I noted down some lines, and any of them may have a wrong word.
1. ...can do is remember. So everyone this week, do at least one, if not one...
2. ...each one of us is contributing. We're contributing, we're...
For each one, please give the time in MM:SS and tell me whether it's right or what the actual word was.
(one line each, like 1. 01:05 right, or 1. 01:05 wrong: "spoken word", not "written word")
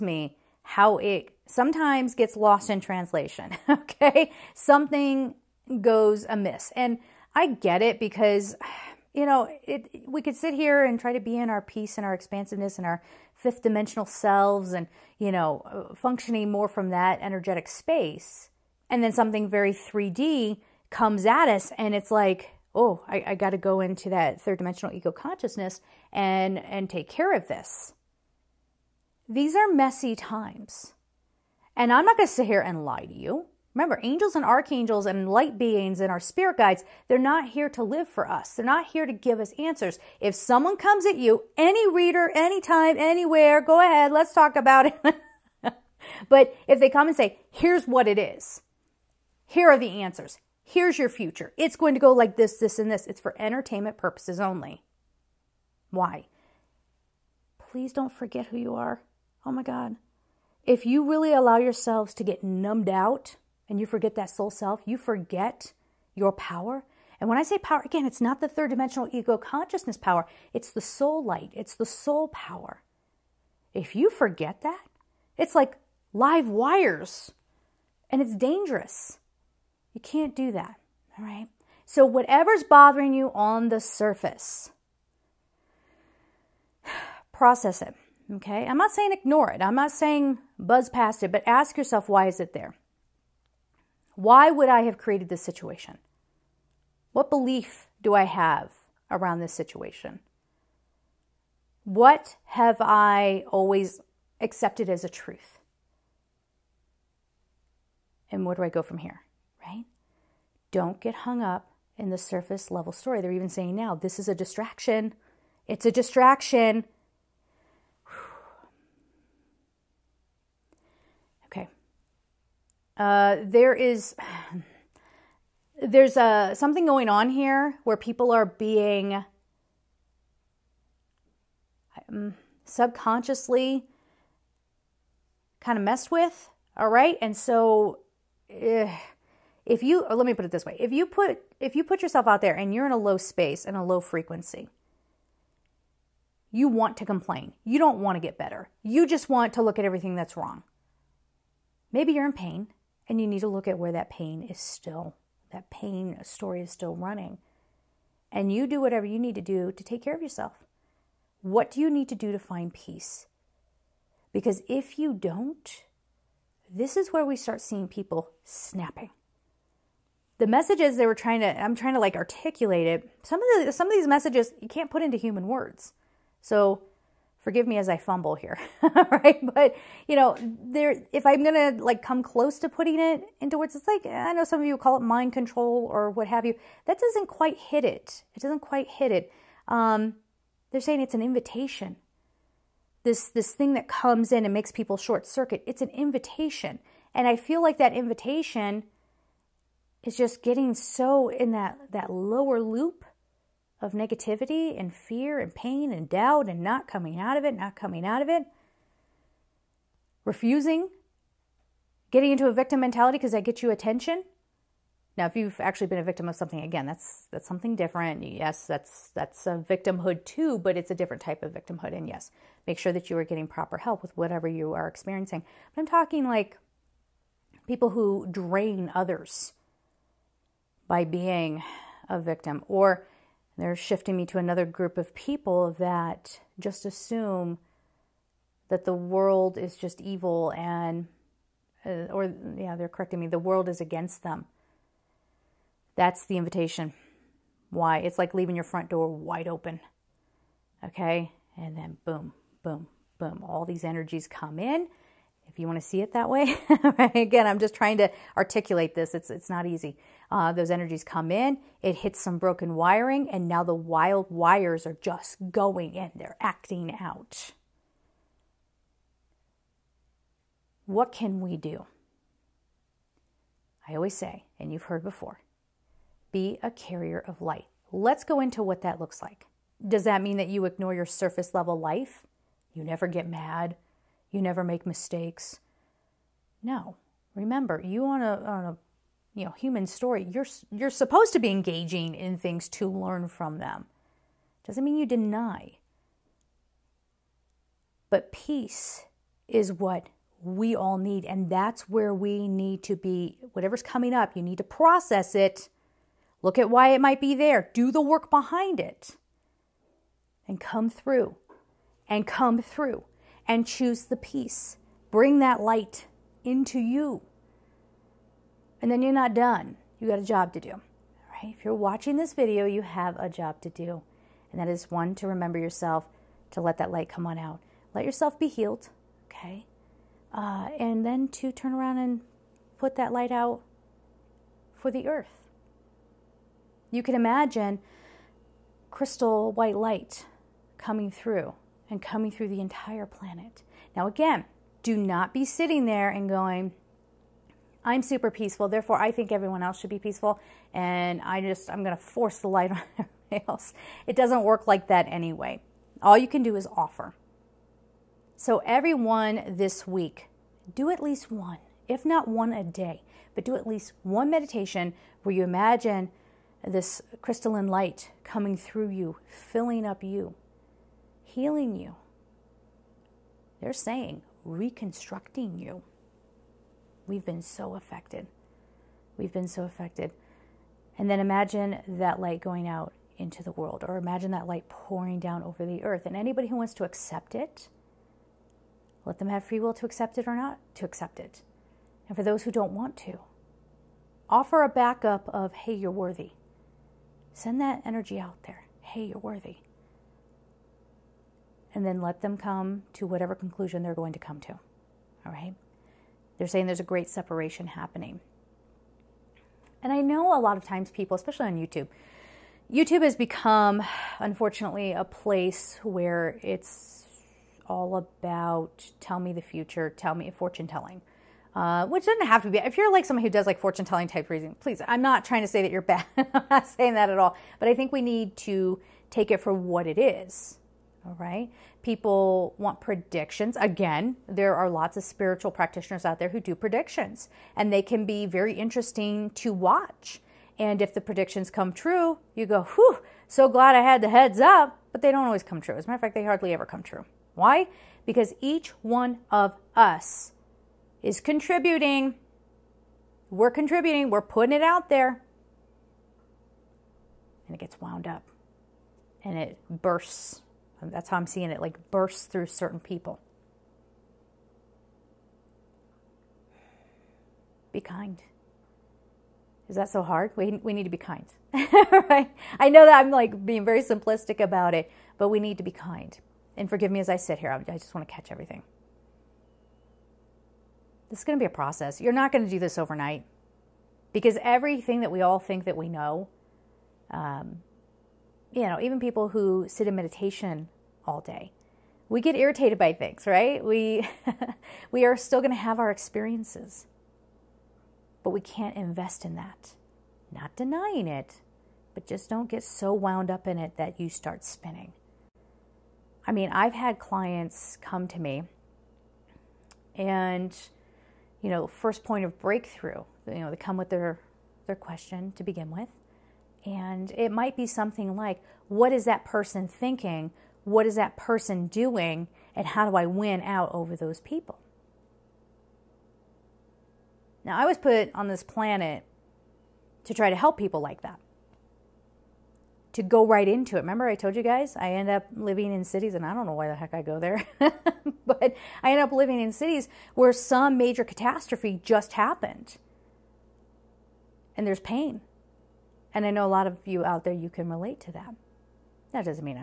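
1. 05:56 wrong: "offer", not "remember"
2. 07:28 right.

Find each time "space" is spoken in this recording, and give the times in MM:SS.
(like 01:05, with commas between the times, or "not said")
00:17, 02:23.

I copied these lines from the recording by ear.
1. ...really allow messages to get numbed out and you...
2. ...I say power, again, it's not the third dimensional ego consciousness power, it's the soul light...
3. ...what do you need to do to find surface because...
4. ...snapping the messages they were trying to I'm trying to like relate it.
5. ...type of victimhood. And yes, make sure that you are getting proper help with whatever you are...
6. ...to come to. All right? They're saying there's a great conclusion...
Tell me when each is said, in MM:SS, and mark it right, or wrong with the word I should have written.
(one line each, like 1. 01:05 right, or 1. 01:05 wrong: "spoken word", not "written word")
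1. 01:01 wrong: "yourselves", not "messages"
2. 01:07 right
3. 02:41 wrong: "peace", not "surface"
4. 02:48 wrong: "articulate", not "relate"
5. 03:41 right
6. 06:44 wrong: "separation", not "conclusion".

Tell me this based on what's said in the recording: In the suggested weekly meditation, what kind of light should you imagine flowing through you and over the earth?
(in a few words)
crystalline light.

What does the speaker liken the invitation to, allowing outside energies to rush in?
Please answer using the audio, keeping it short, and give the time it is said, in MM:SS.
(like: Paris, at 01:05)
leaving your front door wide open, at 04:08.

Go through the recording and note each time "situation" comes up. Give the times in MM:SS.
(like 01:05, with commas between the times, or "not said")
01:35, 01:39.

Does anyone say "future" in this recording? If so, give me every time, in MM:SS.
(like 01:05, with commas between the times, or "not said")
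00:51, 06:59.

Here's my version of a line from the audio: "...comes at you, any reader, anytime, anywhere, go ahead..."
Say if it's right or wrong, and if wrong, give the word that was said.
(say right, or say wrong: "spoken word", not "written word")
right.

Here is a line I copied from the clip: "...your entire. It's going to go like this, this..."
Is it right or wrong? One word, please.
wrong.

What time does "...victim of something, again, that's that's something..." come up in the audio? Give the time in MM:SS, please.
03:36.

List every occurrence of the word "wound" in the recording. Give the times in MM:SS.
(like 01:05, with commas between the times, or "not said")
07:37, 08:22.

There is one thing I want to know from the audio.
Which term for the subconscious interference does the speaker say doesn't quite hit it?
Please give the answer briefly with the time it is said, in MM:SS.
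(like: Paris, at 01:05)
mind control, at 03:05.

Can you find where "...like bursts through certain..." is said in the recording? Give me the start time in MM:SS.
07:41.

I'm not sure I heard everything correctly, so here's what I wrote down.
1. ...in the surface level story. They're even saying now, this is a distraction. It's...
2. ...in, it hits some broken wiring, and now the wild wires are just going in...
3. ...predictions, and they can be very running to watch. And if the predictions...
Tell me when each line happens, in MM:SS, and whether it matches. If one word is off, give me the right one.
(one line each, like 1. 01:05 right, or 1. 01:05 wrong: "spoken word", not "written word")
1. 01:51 right
2. 04:21 right
3. 07:16 wrong: "interesting", not "running".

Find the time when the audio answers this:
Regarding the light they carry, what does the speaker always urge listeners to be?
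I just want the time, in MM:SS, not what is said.
04:36.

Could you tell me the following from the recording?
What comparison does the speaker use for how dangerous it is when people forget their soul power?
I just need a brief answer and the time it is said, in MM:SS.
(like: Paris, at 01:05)
live wires, at 01:16.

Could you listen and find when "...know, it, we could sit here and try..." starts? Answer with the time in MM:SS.
00:09.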